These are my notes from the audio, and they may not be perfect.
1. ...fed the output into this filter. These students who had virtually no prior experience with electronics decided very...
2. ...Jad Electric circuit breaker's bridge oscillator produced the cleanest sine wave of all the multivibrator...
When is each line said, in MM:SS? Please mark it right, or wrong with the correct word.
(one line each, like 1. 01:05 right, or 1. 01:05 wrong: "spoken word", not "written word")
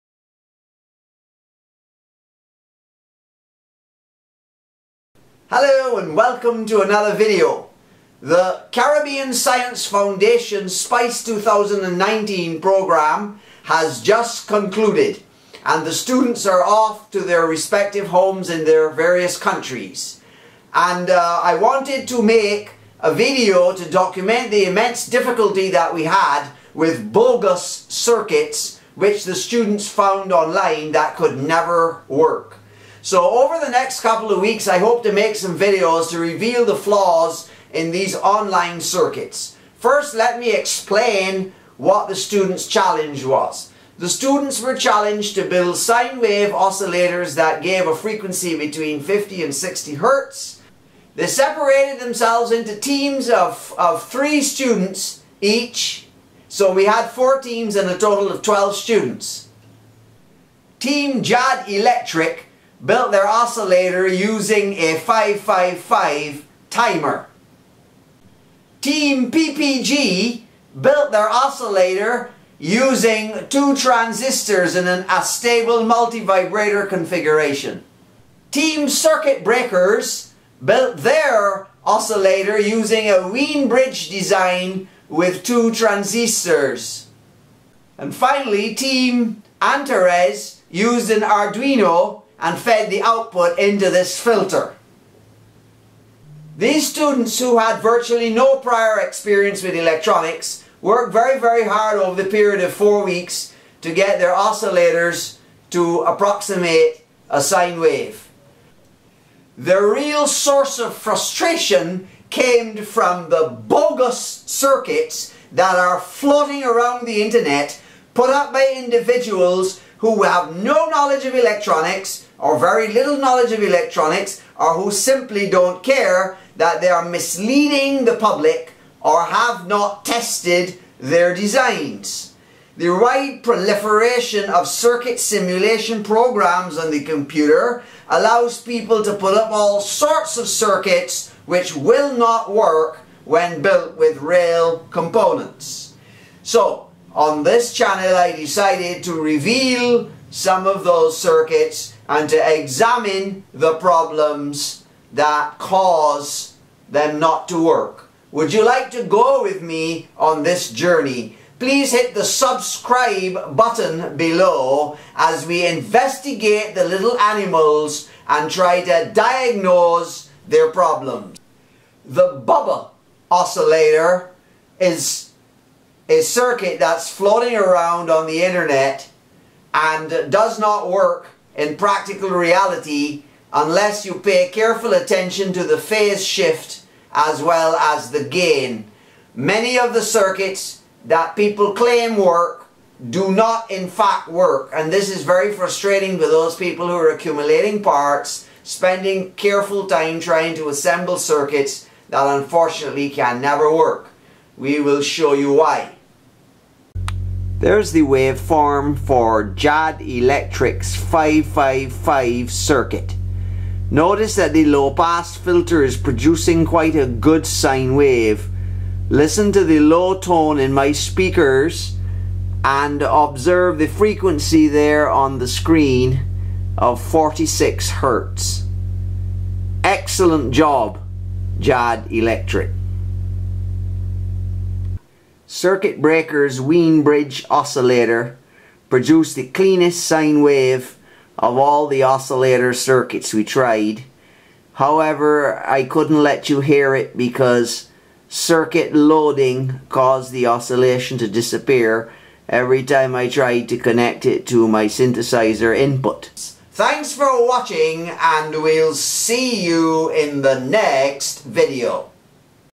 1. 01:32 wrong: "worked", not "decided"
2. 03:51 wrong: "oscillator", not "multivibrator".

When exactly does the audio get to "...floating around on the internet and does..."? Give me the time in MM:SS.
02:57.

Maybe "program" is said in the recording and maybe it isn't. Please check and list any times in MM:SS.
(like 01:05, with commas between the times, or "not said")
00:12, 02:16.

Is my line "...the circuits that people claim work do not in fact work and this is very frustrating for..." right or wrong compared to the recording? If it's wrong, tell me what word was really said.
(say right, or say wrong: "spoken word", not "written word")
right.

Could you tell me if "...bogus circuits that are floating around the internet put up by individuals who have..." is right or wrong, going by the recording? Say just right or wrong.
right.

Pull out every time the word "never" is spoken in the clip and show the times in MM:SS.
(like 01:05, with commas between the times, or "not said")
00:31, 03:23.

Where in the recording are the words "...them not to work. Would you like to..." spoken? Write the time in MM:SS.
02:36.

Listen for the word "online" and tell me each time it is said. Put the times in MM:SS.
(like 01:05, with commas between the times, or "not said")
00:30, 00:38.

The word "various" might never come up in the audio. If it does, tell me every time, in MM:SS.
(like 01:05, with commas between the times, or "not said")
00:18.